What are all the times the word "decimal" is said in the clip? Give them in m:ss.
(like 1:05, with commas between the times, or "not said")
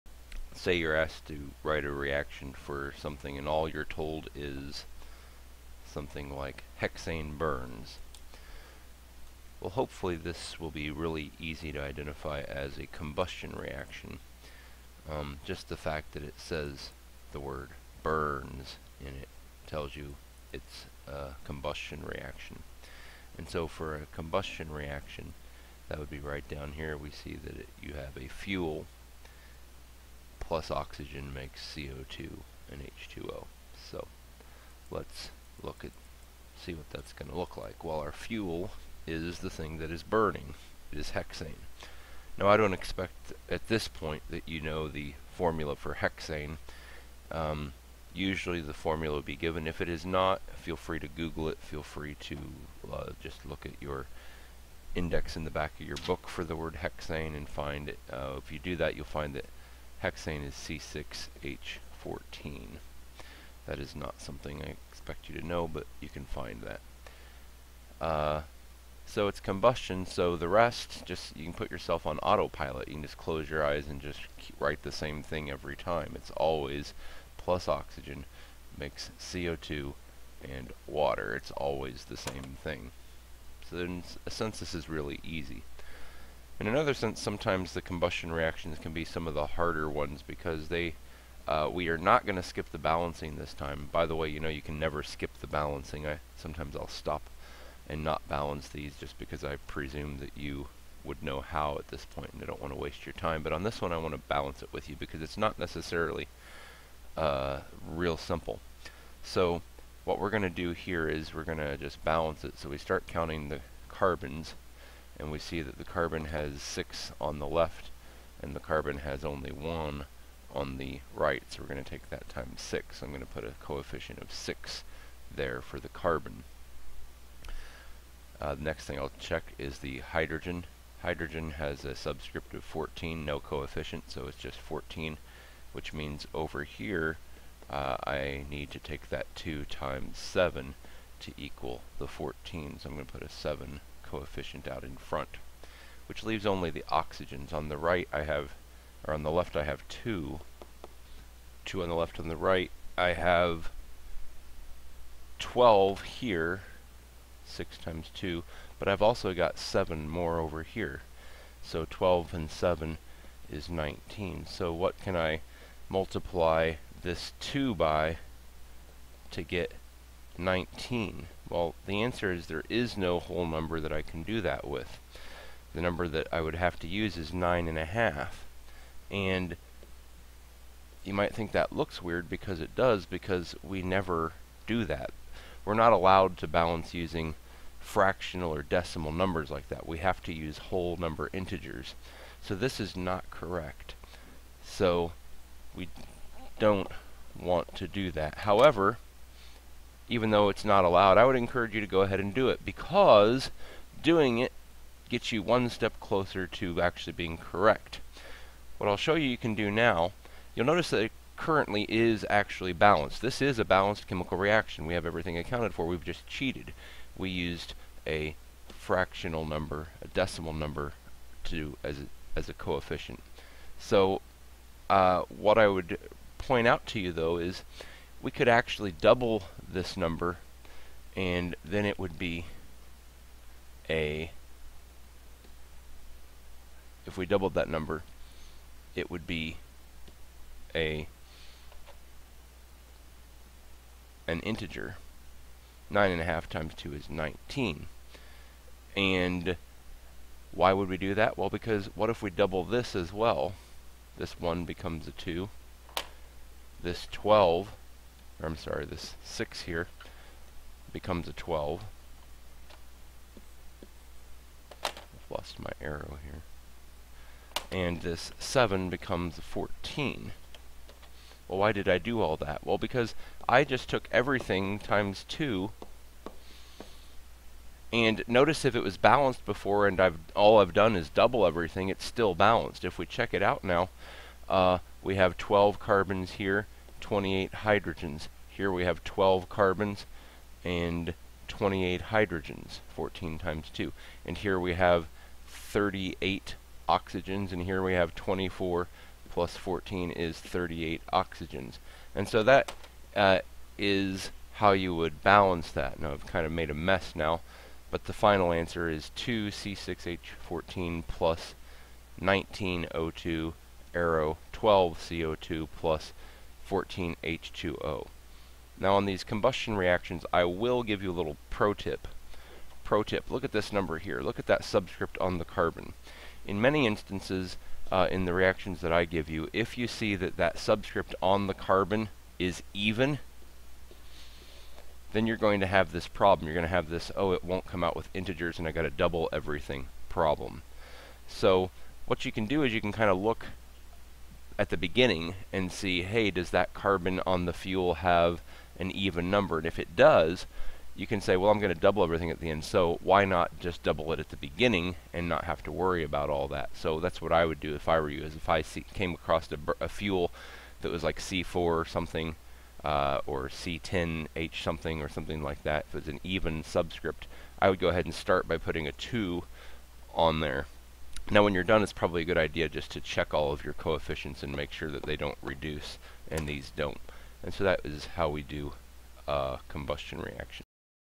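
3:08, 3:40.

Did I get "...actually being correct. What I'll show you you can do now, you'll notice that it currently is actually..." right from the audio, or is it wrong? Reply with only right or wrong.
right.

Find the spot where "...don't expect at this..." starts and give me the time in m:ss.
0:42.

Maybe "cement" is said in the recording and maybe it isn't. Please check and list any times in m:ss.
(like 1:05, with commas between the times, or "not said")
not said.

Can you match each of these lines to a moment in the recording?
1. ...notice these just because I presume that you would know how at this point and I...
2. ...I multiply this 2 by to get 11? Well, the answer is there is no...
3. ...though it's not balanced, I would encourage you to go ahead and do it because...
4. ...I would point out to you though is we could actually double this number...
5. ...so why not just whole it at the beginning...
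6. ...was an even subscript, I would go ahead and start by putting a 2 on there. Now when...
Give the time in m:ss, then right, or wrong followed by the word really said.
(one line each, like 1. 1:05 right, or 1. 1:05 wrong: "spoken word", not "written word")
1. 1:38 wrong: "balance", not "notice"
2. 2:45 wrong: "19", not "11"
3. 3:20 wrong: "allowed", not "balanced"
4. 3:45 right
5. 5:52 wrong: "double", not "whole"
6. 6:05 right.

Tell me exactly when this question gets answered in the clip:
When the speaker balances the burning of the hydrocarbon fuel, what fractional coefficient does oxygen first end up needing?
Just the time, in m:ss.
2:57.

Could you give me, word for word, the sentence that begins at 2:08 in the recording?
Uh, the next thing I'll check is the hydrogen.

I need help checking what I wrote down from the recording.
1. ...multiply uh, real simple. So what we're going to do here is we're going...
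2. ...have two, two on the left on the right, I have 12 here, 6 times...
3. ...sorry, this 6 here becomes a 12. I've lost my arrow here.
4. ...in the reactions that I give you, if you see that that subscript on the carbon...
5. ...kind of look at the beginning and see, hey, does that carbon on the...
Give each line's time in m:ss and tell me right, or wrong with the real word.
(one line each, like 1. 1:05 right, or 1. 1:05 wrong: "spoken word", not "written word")
1. 1:45 wrong: "necessarily", not "multiply"
2. 2:29 right
3. 4:18 right
4. 5:28 right
5. 5:42 right.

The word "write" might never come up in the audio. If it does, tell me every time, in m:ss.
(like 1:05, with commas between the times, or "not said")
0:01, 1:14.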